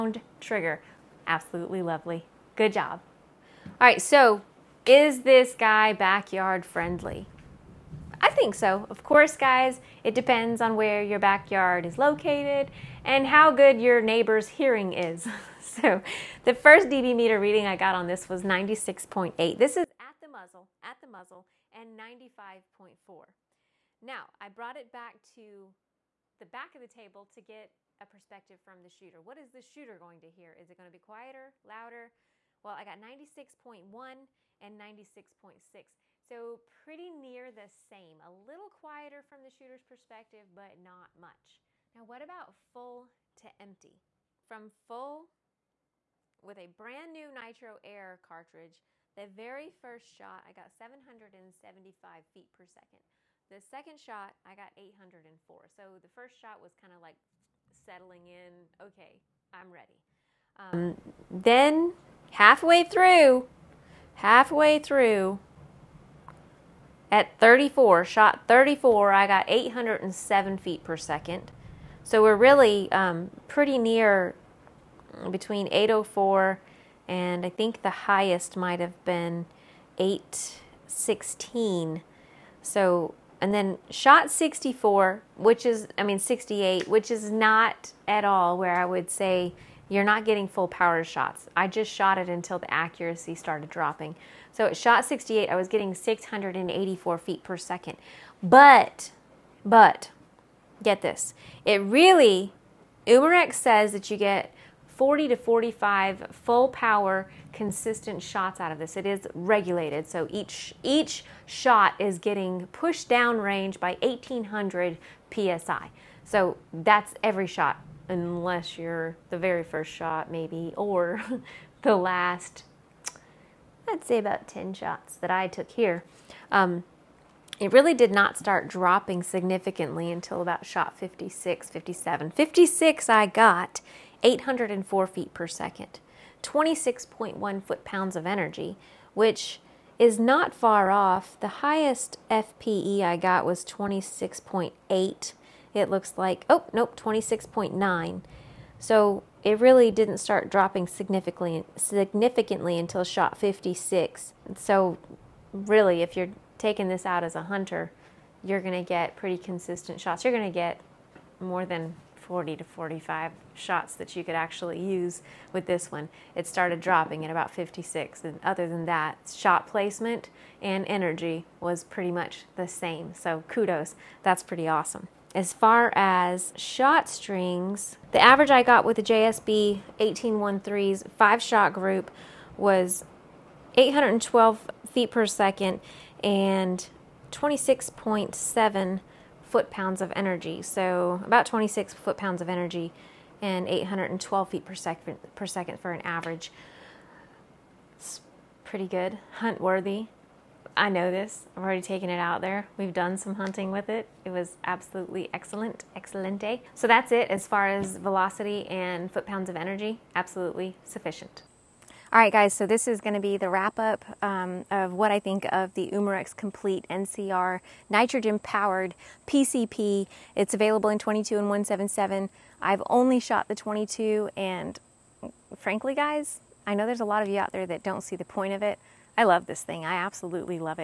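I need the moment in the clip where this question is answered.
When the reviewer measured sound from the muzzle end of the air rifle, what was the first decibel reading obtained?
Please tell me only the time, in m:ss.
0:18.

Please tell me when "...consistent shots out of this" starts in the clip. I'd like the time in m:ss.
1:47.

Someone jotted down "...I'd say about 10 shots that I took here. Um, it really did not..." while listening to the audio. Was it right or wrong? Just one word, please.
right.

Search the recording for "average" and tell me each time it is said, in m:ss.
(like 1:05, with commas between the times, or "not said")
2:58, 3:15.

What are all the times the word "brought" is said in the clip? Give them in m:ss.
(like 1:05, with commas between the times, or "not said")
0:24.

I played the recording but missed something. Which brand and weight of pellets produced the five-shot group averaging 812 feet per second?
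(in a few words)
JSB 18.13.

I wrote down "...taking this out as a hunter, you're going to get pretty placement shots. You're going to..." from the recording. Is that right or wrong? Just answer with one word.
wrong.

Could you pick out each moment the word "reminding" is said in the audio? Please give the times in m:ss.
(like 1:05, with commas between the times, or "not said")
not said.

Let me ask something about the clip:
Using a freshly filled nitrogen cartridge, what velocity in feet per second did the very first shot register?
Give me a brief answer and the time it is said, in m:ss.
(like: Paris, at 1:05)
775, at 0:50.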